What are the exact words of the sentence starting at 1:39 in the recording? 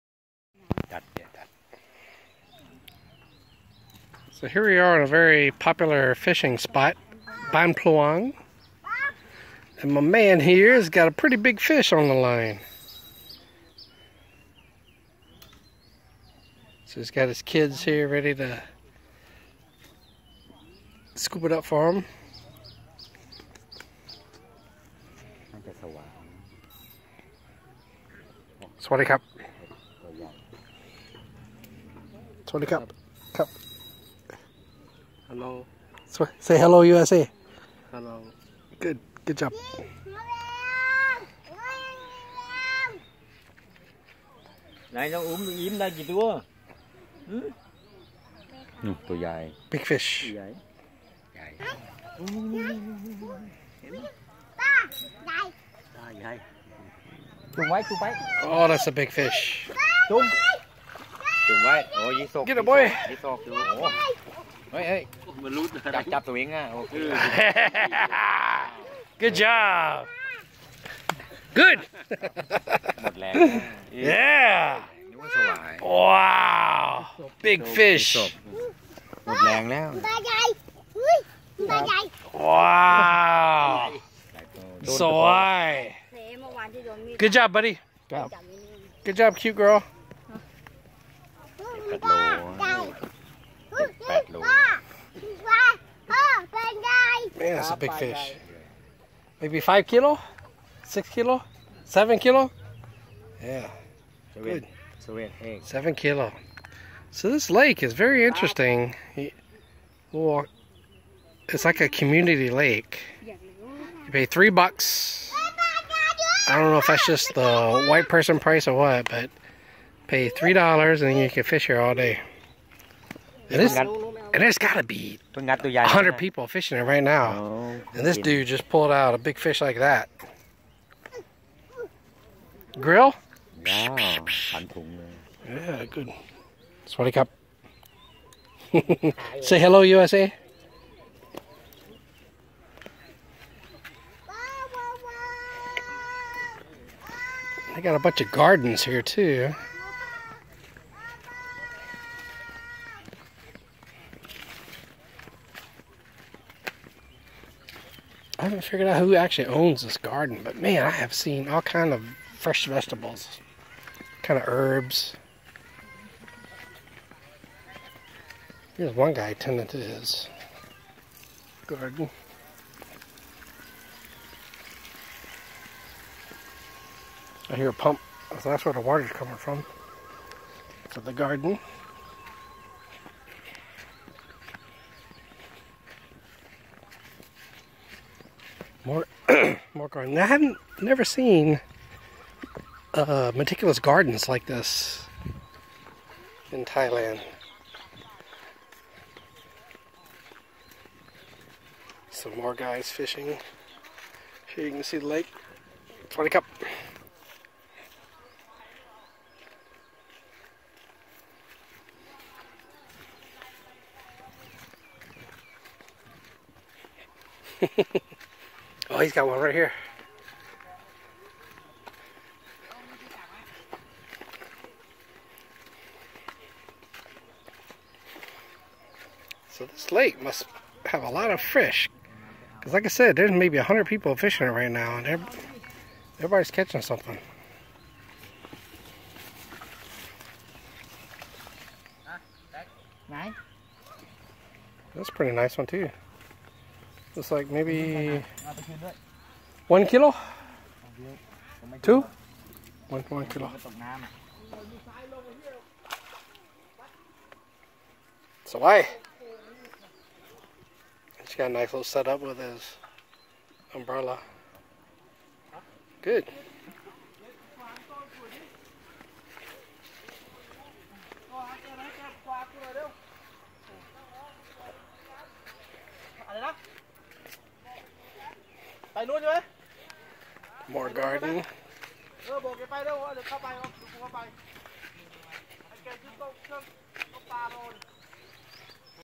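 Maybe five kilo, six kilo, seven kilo.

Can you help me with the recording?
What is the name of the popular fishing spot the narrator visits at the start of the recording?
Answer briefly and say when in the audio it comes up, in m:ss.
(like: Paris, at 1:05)
Ban Pluang, at 0:07.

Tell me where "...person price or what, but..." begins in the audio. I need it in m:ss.
1:58.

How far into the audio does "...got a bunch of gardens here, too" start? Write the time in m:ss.
2:27.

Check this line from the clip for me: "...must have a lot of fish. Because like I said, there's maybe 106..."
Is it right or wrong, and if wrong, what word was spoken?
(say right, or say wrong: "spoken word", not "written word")
wrong: "100", not "106".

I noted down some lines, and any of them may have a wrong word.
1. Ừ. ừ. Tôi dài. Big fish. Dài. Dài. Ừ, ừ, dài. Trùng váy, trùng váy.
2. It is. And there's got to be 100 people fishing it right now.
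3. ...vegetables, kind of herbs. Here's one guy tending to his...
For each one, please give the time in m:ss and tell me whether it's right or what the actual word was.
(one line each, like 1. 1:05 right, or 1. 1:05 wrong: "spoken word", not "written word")
1. 0:47 right
2. 2:03 right
3. 2:42 right.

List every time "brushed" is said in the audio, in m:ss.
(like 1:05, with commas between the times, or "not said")
not said.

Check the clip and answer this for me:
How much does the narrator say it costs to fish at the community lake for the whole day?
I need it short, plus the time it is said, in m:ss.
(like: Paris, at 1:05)
3 dollars, at 1:54.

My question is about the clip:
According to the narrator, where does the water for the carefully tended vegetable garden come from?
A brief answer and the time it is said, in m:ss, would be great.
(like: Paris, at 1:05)
A pump, at 2:57.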